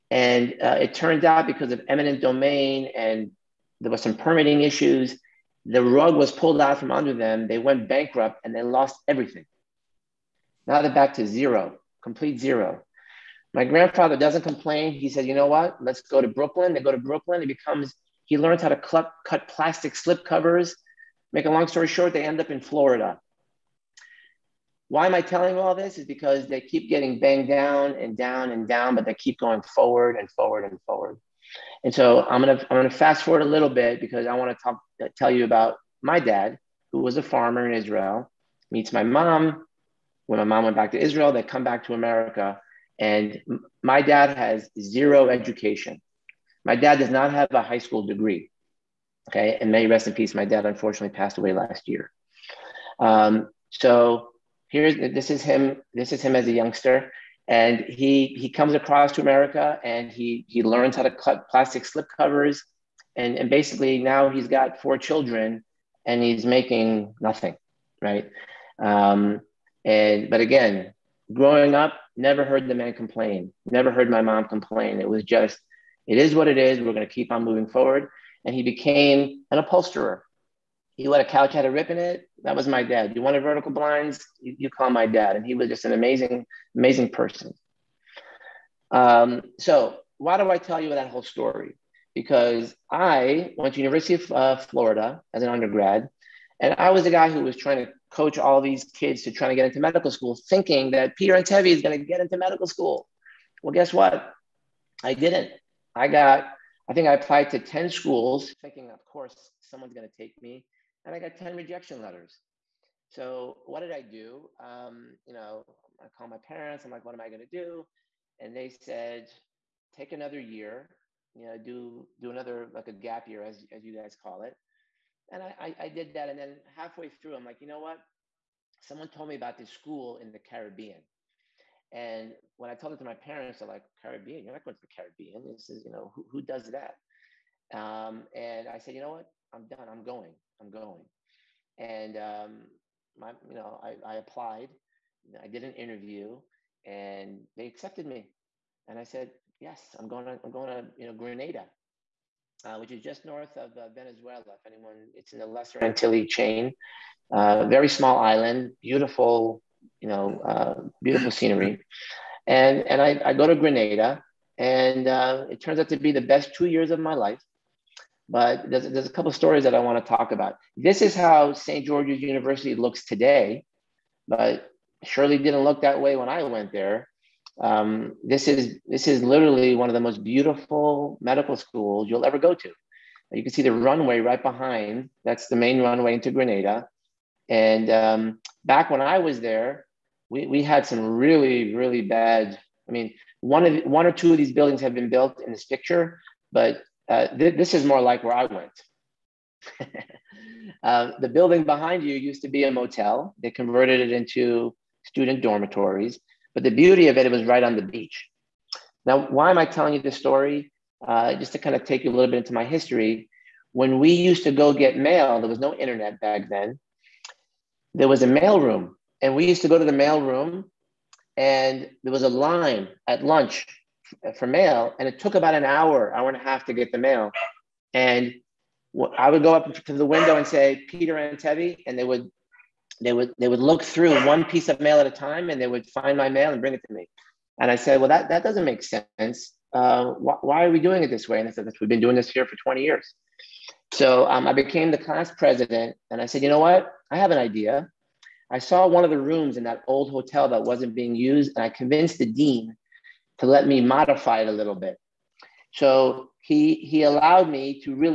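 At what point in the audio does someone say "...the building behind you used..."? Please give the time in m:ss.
3:21.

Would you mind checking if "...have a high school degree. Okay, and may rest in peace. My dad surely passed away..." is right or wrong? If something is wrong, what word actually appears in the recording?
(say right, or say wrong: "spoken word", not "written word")
wrong: "unfortunately", not "surely".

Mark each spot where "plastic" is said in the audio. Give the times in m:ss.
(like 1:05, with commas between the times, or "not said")
0:19, 1:01.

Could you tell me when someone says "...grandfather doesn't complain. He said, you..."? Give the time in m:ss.
0:13.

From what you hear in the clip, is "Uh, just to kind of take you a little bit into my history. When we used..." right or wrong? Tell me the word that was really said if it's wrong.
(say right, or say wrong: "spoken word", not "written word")
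right.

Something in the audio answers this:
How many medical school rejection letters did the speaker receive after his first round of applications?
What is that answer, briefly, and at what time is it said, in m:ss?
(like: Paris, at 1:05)
10, at 1:51.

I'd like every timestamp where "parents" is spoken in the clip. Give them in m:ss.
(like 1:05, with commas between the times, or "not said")
1:56, 2:13.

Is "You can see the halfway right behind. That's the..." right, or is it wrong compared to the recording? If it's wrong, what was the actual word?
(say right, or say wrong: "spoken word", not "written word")
wrong: "runway", not "halfway".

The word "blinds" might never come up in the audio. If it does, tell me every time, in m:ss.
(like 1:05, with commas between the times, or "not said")
1:23.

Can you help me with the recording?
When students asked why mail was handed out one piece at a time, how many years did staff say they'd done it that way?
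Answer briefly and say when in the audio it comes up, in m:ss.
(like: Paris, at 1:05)
20 years, at 4:02.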